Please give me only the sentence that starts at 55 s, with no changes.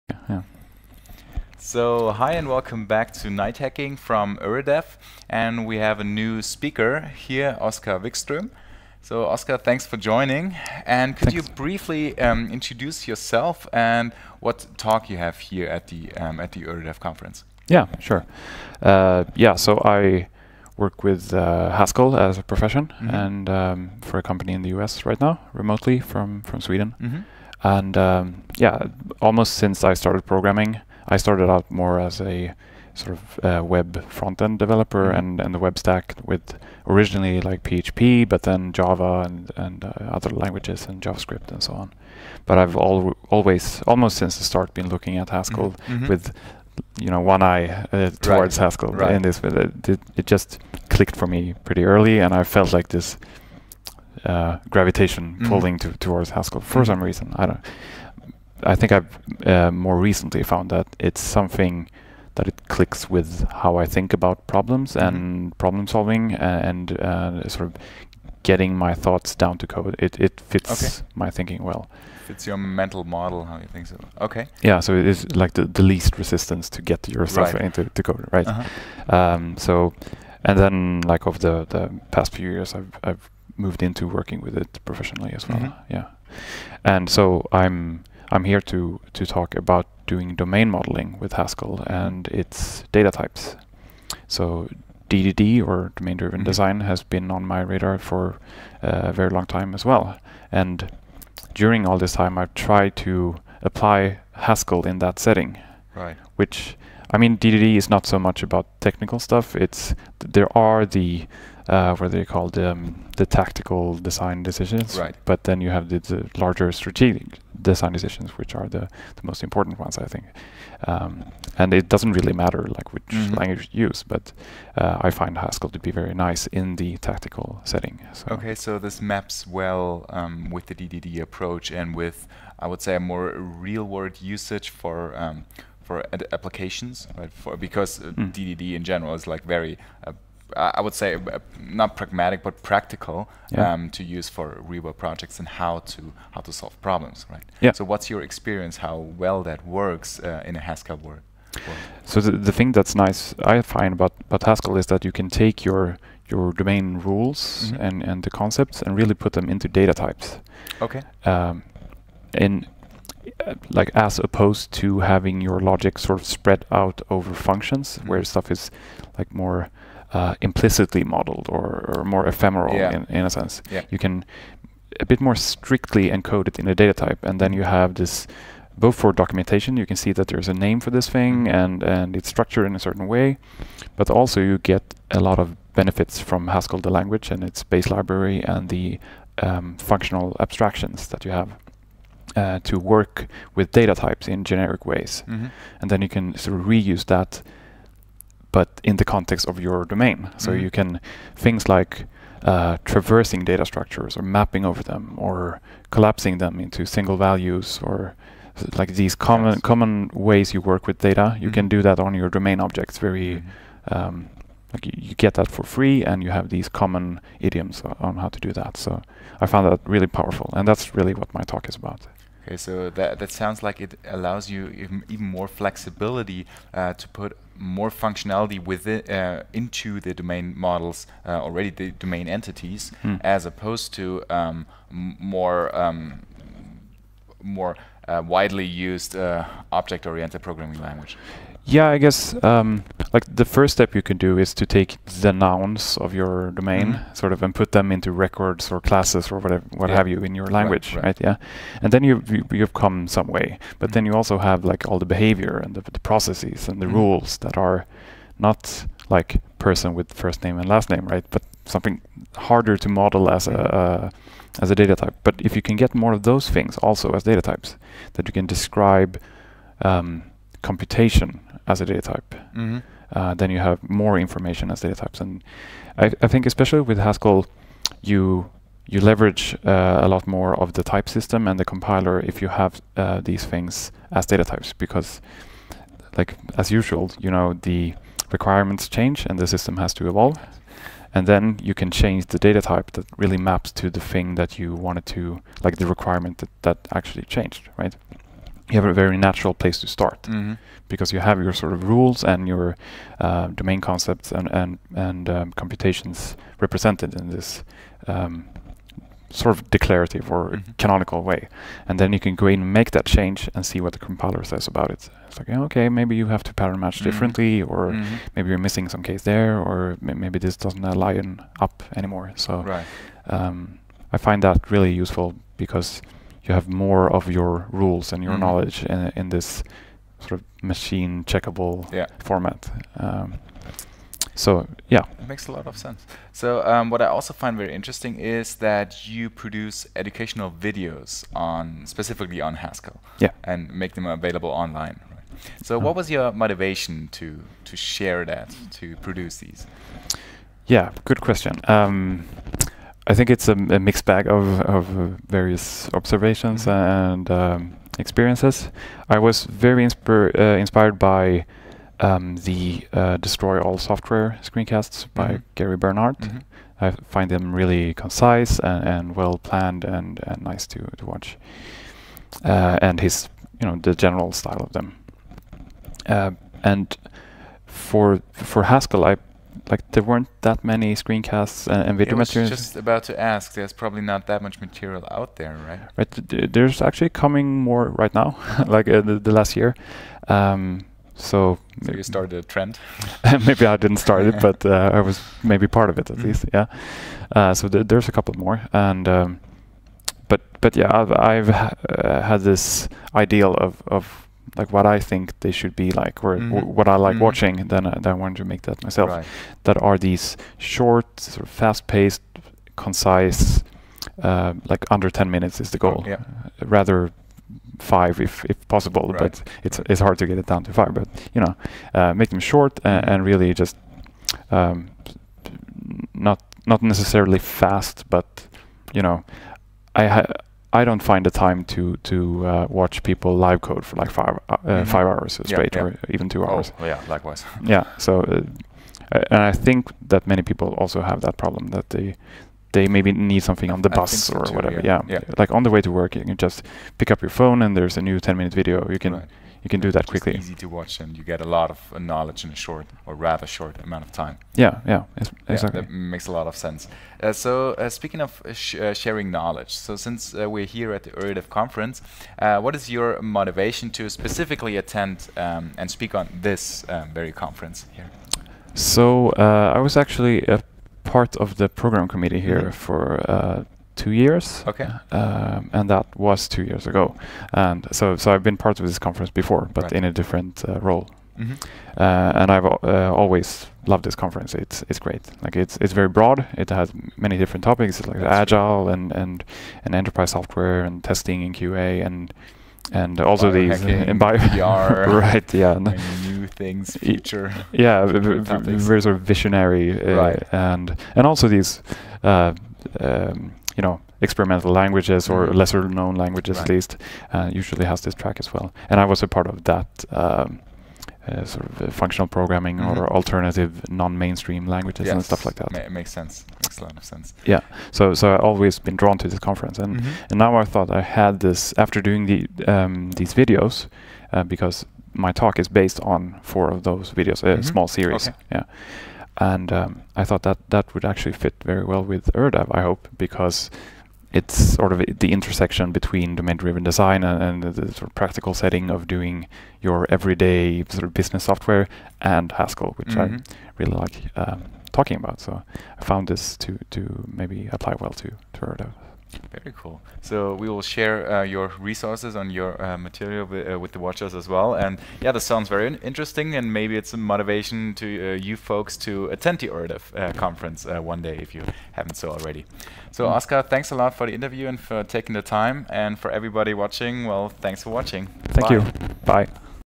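pulling to, towards Haskell for mm-hmm.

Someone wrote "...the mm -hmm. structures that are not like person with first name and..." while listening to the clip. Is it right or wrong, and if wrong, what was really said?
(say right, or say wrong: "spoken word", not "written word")
wrong: "rules", not "structures".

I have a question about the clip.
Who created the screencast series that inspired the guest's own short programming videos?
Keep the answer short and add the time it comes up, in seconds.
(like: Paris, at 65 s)
Gary Bernhardt, at 365 s.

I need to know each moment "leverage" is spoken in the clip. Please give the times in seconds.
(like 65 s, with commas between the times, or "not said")
278 s.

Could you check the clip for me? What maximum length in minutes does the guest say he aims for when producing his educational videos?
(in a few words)
10 minutes.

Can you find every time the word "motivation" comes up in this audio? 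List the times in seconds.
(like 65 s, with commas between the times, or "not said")
346 s, 463 s, 557 s.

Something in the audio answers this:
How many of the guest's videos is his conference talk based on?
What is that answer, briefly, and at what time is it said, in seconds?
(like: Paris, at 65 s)
4, at 526 s.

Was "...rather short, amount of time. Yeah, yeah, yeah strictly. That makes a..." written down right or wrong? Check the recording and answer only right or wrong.
wrong.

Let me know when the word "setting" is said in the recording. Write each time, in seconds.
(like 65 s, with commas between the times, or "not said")
105 s, 127 s, 538 s.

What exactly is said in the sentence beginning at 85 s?
Yeah, and so I'm I'm here to, to talk about doing domain modeling with Haskell and its data types.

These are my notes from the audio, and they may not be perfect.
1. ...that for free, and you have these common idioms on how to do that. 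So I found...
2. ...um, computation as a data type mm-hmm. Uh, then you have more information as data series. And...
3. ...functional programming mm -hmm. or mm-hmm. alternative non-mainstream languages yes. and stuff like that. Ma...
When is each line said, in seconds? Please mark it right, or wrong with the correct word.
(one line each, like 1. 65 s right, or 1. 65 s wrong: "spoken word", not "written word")
1. 215 s right
2. 269 s wrong: "types", not "series"
3. 511 s right.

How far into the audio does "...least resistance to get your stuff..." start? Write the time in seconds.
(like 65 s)
75 s.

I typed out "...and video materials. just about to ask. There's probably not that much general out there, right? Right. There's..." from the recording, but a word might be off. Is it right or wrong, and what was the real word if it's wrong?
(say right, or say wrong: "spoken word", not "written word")
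wrong: "material", not "general".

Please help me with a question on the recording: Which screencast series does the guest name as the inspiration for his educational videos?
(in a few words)
Destroy All Software.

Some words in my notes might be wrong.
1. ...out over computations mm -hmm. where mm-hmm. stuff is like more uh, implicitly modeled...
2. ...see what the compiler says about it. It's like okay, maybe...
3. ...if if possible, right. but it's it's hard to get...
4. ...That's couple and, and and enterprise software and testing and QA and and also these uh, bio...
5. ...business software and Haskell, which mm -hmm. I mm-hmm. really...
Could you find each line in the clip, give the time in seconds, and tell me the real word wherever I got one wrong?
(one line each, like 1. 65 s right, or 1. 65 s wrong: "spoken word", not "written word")
1. 166 s wrong: "functions", not "computations"
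2. 313 s right
3. 418 s right
4. 488 s wrong: "agile", not "couple"
5. 541 s right.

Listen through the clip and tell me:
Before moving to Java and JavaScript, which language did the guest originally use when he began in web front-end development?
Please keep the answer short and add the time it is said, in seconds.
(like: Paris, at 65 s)
PHP, at 37 s.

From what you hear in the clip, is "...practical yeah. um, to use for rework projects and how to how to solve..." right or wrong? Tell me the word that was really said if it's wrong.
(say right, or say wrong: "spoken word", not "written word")
right.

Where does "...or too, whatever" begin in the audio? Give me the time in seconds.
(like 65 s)
444 s.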